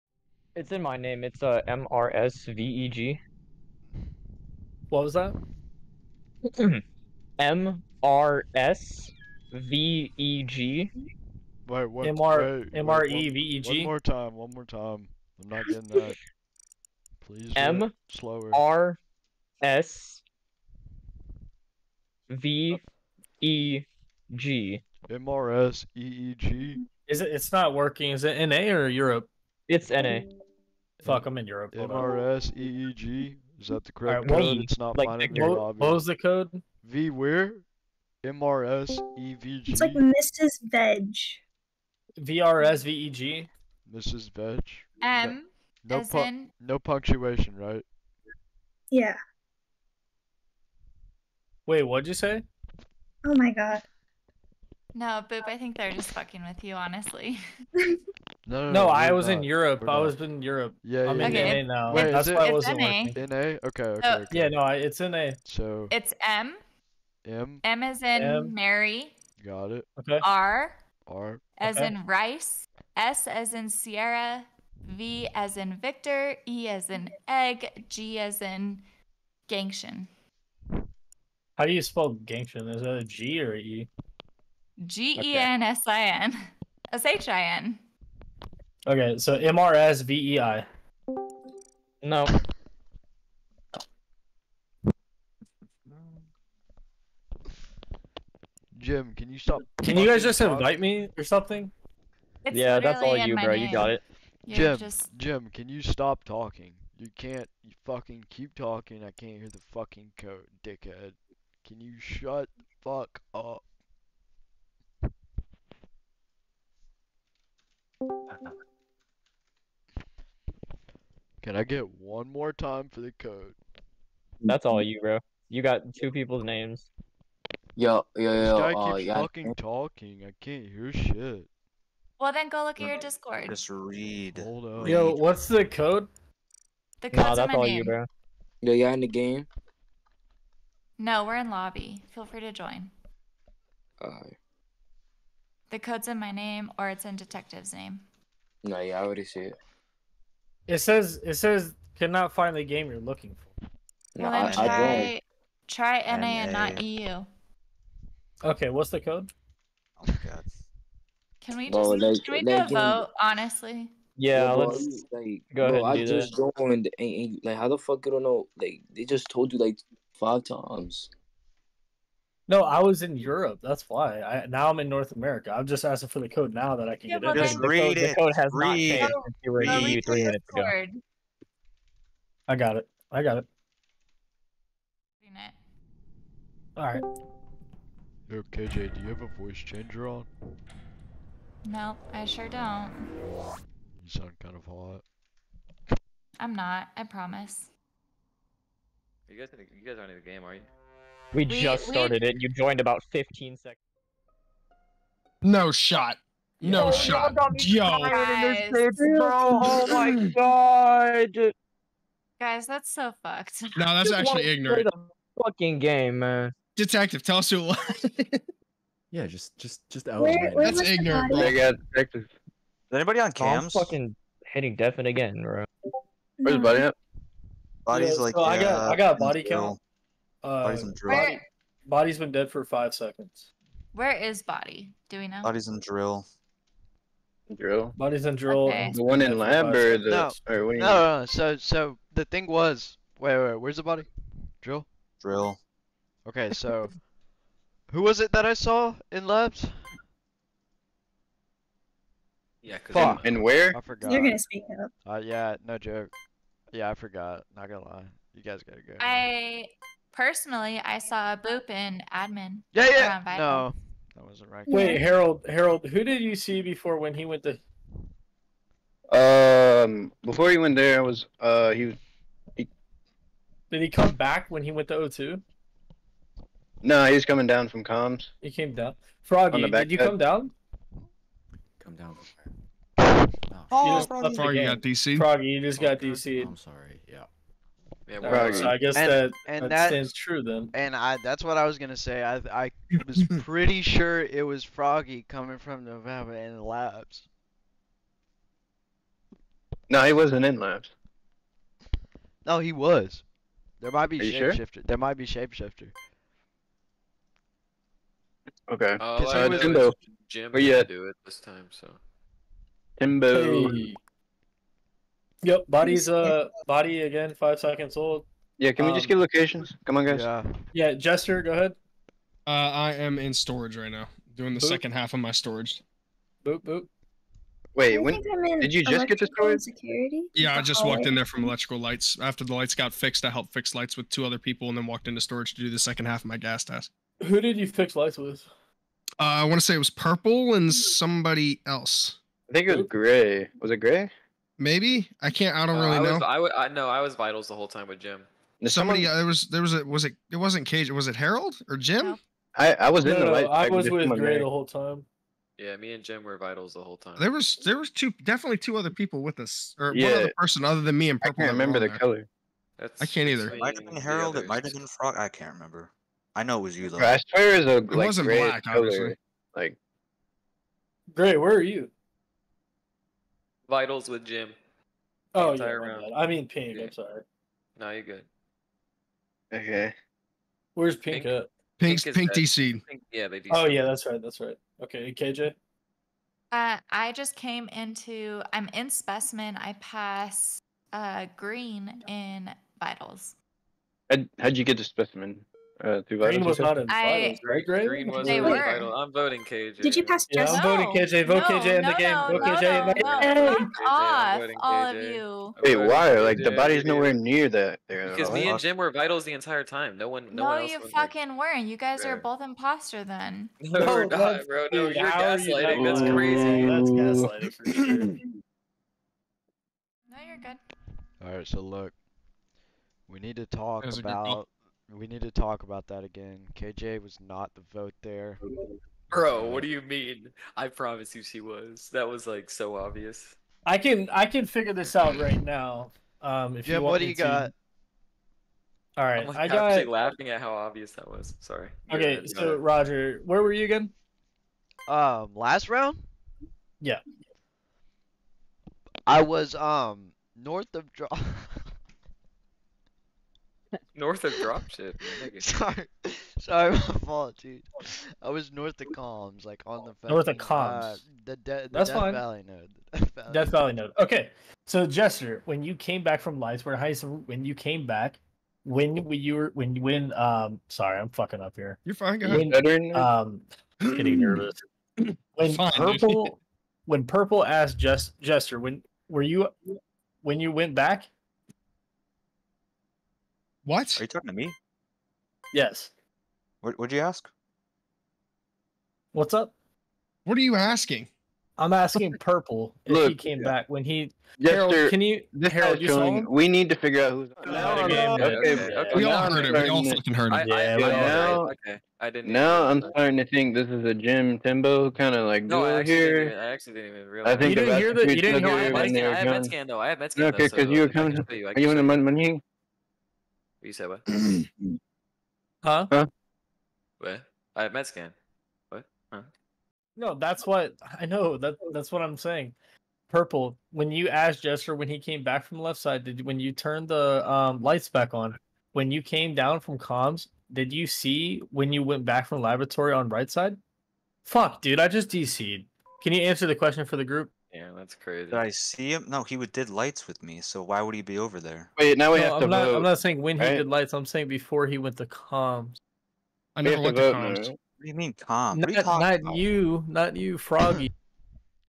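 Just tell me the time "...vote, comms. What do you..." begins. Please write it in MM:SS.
09:07.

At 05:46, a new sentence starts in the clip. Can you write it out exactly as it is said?
I know I was vitals the whole time with Jim.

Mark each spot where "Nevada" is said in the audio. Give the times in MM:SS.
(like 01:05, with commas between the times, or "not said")
04:55.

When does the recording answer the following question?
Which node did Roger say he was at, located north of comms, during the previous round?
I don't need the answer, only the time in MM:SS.
07:42.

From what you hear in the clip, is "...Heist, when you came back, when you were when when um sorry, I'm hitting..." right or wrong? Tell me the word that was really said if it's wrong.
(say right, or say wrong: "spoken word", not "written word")
wrong: "fucking", not "hitting".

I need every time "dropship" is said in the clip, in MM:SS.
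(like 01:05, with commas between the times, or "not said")
07:34.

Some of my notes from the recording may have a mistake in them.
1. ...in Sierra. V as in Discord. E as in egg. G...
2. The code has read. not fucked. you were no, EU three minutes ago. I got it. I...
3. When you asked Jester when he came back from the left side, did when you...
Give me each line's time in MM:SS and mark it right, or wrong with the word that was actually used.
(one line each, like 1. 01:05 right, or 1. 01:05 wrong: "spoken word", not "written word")
1. 01:13 wrong: "Victor", not "Discord"
2. 02:58 wrong: "changed", not "fucked"
3. 08:43 right.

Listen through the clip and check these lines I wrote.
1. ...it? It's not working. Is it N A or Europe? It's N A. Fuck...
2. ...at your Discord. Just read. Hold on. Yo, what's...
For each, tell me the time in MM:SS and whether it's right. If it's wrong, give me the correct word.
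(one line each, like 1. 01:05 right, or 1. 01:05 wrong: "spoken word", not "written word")
1. 00:27 right
2. 02:12 right.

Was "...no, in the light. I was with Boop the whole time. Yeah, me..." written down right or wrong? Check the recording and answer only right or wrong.
wrong.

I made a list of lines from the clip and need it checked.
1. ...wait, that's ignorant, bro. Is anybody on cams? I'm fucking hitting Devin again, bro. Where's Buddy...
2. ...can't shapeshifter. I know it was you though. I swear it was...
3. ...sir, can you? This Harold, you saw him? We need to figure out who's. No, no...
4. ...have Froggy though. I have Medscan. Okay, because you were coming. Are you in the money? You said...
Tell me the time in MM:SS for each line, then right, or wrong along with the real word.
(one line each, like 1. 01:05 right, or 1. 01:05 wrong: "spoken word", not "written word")
1. 03:40 right
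2. 06:05 wrong: "remember", not "shapeshifter"
3. 08:14 right
4. 08:29 wrong: "Medscan", not "Froggy".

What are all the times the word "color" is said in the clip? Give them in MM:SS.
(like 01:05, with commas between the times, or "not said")
06:01, 06:08.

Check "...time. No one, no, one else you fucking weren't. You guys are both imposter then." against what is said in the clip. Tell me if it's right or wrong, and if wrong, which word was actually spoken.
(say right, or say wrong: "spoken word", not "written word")
right.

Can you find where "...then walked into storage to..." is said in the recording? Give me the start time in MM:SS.
05:34.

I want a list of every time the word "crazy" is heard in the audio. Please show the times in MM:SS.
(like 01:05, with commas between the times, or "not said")
06:56, 08:57.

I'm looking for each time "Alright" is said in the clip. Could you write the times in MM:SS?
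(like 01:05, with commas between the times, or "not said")
02:23, 07:01.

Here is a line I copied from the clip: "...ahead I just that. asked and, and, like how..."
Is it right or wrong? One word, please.
wrong.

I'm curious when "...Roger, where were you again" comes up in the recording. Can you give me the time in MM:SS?
07:22.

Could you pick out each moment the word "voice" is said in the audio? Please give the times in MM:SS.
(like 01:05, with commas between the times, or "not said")
03:09.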